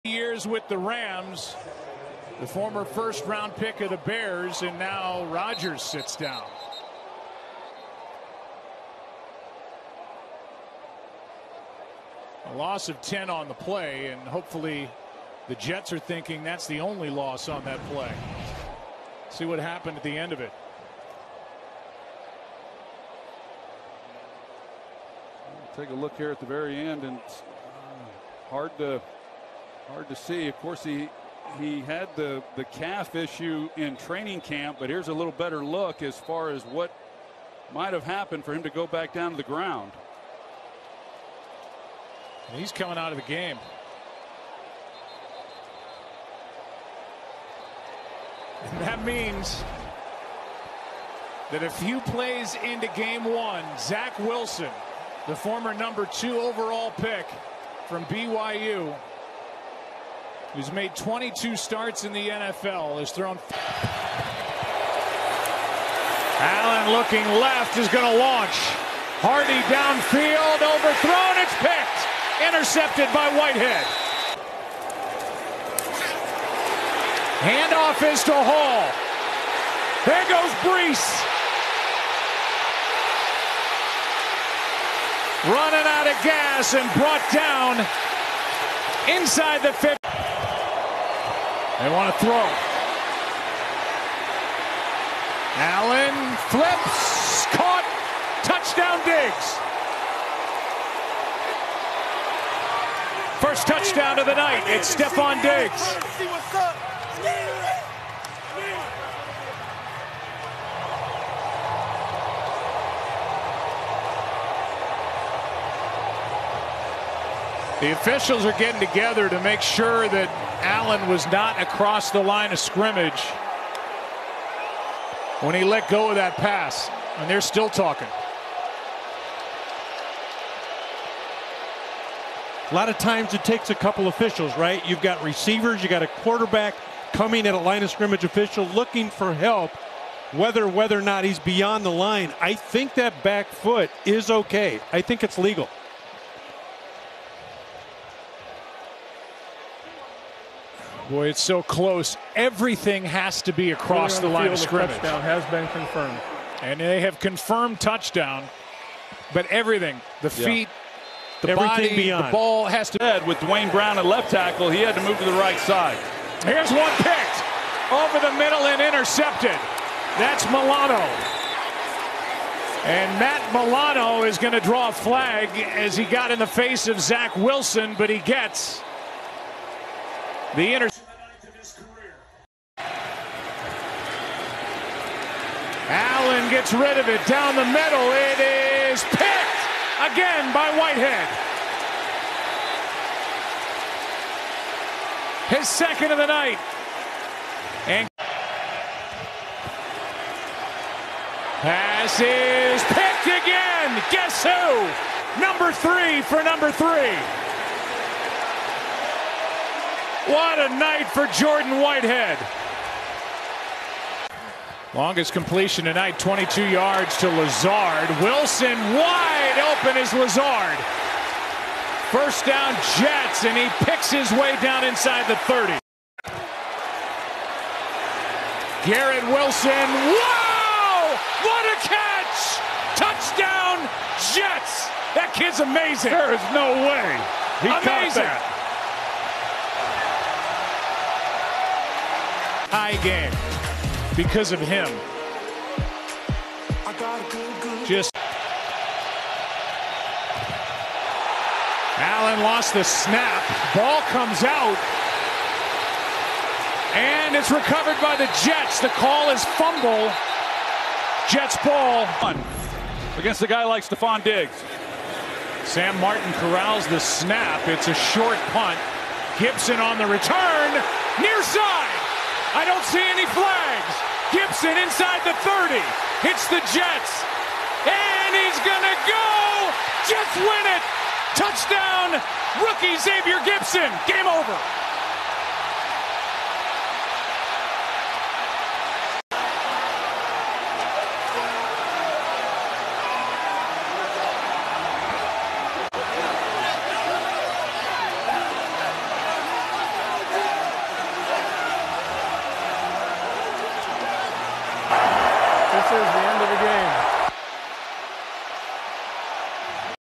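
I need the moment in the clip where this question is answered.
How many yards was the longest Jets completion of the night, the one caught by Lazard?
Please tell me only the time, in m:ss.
3:36.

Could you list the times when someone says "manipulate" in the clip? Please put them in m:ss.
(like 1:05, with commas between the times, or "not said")
not said.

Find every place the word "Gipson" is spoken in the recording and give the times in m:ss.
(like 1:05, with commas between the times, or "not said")
4:29, 4:34, 4:43.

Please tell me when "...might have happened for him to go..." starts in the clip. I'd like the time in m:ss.
0:37.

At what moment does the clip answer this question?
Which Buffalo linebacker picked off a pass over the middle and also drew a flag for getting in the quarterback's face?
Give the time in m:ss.
2:53.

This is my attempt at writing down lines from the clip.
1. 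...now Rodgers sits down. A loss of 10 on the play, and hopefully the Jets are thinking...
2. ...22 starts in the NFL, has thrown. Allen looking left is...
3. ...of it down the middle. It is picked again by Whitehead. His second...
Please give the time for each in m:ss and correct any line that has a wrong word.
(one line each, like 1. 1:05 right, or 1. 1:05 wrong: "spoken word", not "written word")
1. 0:04 right
2. 1:00 right
3. 3:06 right.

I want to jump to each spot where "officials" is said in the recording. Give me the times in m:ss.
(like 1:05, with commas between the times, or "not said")
1:57, 2:14, 2:18.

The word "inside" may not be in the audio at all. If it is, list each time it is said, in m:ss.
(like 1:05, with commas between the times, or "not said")
1:29, 3:44, 4:34.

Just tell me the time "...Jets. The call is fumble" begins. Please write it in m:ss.
4:18.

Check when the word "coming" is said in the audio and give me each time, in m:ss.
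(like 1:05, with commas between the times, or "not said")
0:42, 2:17.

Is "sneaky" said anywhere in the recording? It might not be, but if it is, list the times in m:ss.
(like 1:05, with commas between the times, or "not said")
not said.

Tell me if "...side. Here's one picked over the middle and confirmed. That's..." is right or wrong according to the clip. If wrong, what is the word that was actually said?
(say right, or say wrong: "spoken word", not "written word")
wrong: "intercepted", not "confirmed".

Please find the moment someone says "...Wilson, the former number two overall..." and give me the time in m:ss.
0:54.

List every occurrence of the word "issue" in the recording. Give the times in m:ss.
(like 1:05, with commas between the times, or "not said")
0:33.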